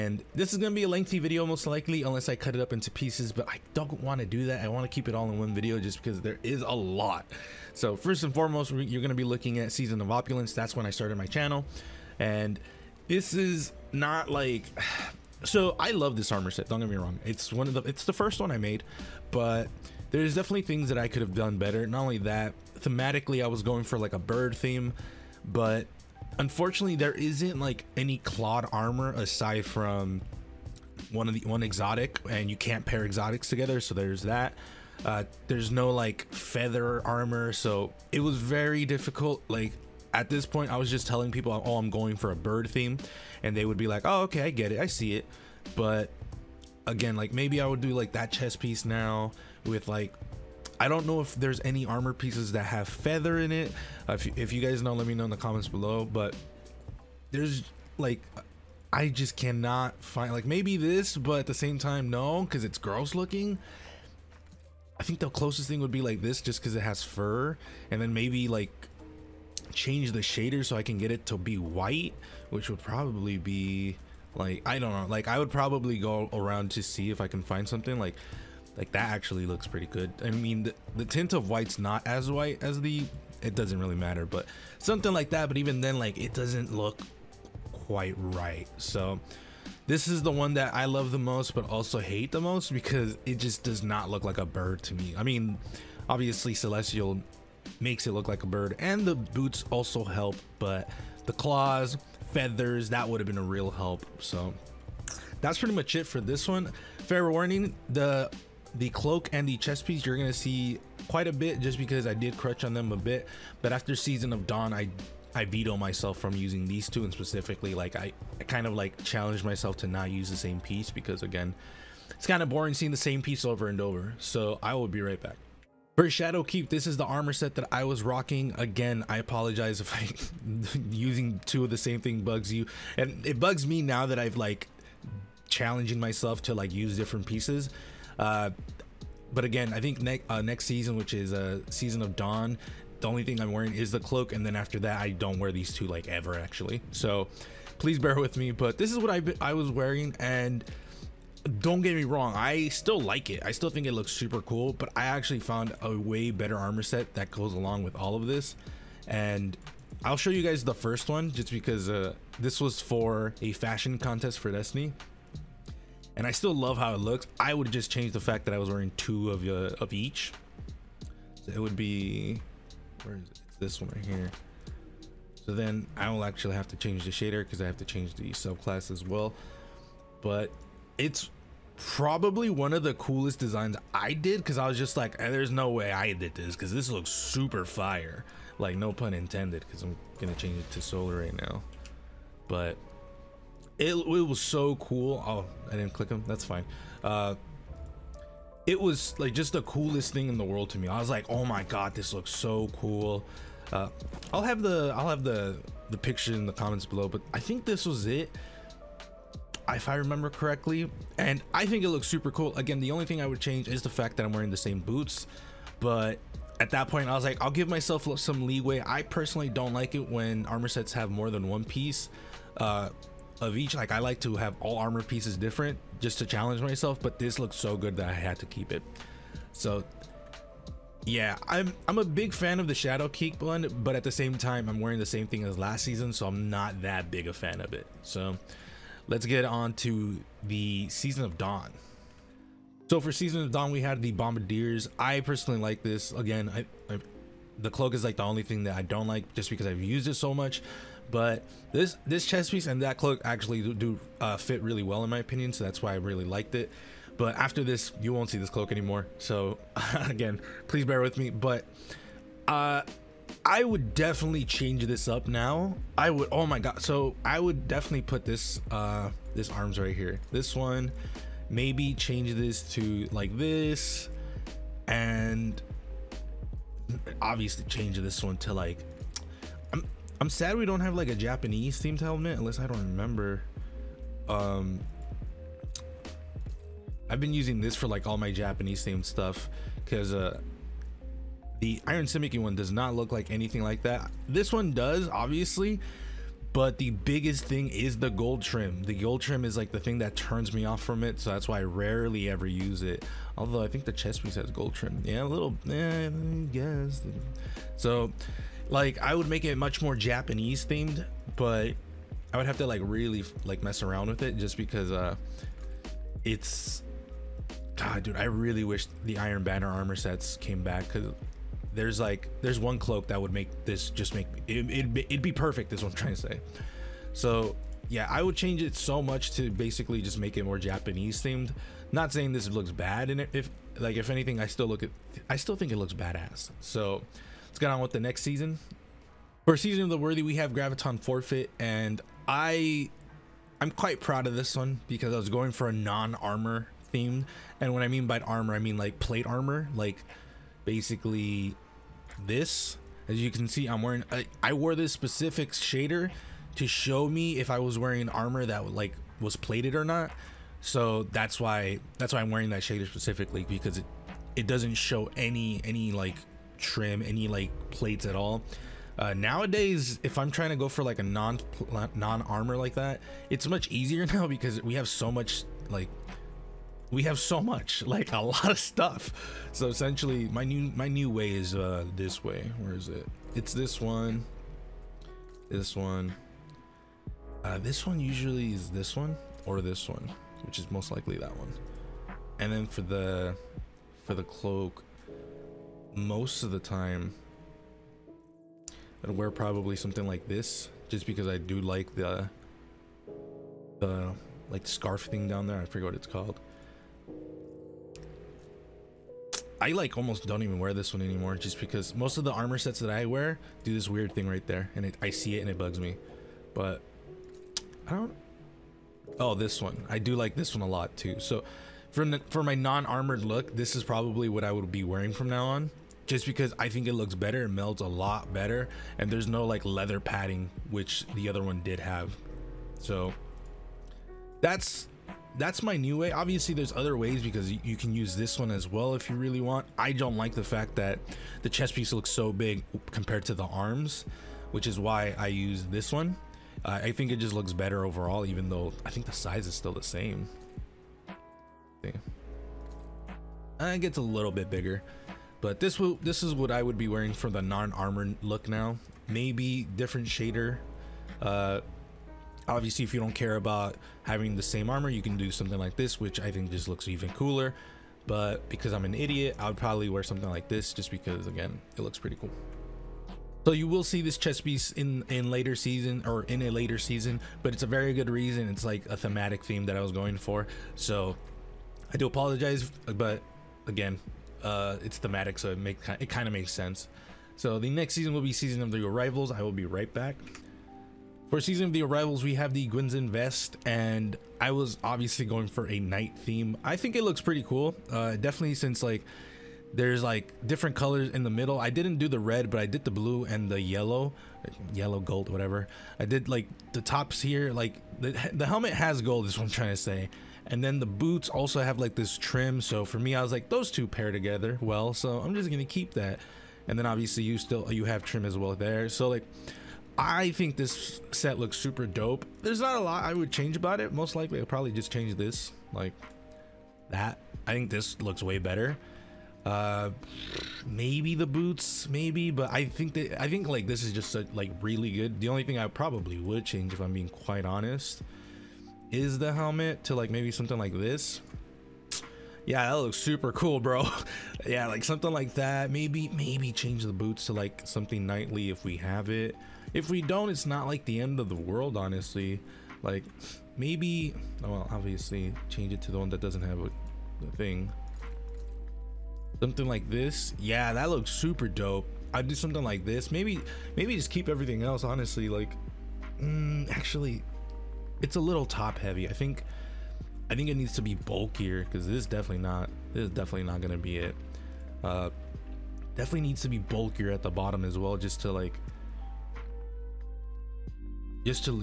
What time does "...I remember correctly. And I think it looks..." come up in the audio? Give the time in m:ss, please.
3:29.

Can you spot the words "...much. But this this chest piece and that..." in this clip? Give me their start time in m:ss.
4:10.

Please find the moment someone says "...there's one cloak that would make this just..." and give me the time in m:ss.
5:22.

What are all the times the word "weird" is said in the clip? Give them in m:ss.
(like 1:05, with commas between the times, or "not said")
6:53.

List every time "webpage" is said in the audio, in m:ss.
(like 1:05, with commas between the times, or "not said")
not said.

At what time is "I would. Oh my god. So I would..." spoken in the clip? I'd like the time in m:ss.
4:25.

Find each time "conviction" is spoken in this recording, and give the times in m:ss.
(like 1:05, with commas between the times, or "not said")
not said.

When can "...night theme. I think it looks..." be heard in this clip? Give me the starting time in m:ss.
8:15.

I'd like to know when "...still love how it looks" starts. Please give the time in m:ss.
2:46.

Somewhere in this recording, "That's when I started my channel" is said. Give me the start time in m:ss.
0:10.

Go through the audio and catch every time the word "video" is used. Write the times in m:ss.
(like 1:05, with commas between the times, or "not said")
0:01, 0:05.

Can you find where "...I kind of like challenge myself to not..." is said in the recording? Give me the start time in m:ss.
1:58.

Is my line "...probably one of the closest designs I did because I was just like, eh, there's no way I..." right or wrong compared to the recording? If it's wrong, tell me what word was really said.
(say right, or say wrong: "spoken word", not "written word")
wrong: "coolest", not "closest".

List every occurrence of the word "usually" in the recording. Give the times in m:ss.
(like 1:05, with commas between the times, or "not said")
6:27.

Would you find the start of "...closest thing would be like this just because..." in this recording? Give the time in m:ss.
1:05.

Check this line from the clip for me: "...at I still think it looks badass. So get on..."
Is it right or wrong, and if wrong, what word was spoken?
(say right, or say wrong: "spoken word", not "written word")
right.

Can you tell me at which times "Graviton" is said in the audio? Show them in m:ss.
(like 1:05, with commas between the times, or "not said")
5:40.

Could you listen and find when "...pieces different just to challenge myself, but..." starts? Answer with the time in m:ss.
3:45.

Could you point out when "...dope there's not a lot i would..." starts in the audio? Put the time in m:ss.
8:41.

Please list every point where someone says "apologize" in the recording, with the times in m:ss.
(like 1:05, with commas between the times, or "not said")
2:09, 8:02.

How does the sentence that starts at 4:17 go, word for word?
But after this, you won't see this cloak anymore.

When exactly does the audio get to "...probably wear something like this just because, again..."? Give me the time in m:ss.
7:49.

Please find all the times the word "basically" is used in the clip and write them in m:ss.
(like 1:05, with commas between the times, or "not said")
5:29, 5:50.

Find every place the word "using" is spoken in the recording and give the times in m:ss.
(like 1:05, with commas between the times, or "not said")
1:56, 2:10, 4:47.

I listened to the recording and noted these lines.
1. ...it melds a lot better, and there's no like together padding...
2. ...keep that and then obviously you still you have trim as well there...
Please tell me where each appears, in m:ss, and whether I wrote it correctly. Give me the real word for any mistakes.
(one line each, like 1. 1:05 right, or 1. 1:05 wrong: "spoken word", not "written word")
1. 7:07 wrong: "leather", not "together"
2. 8:35 right.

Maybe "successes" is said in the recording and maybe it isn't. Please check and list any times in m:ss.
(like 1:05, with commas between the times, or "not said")
not said.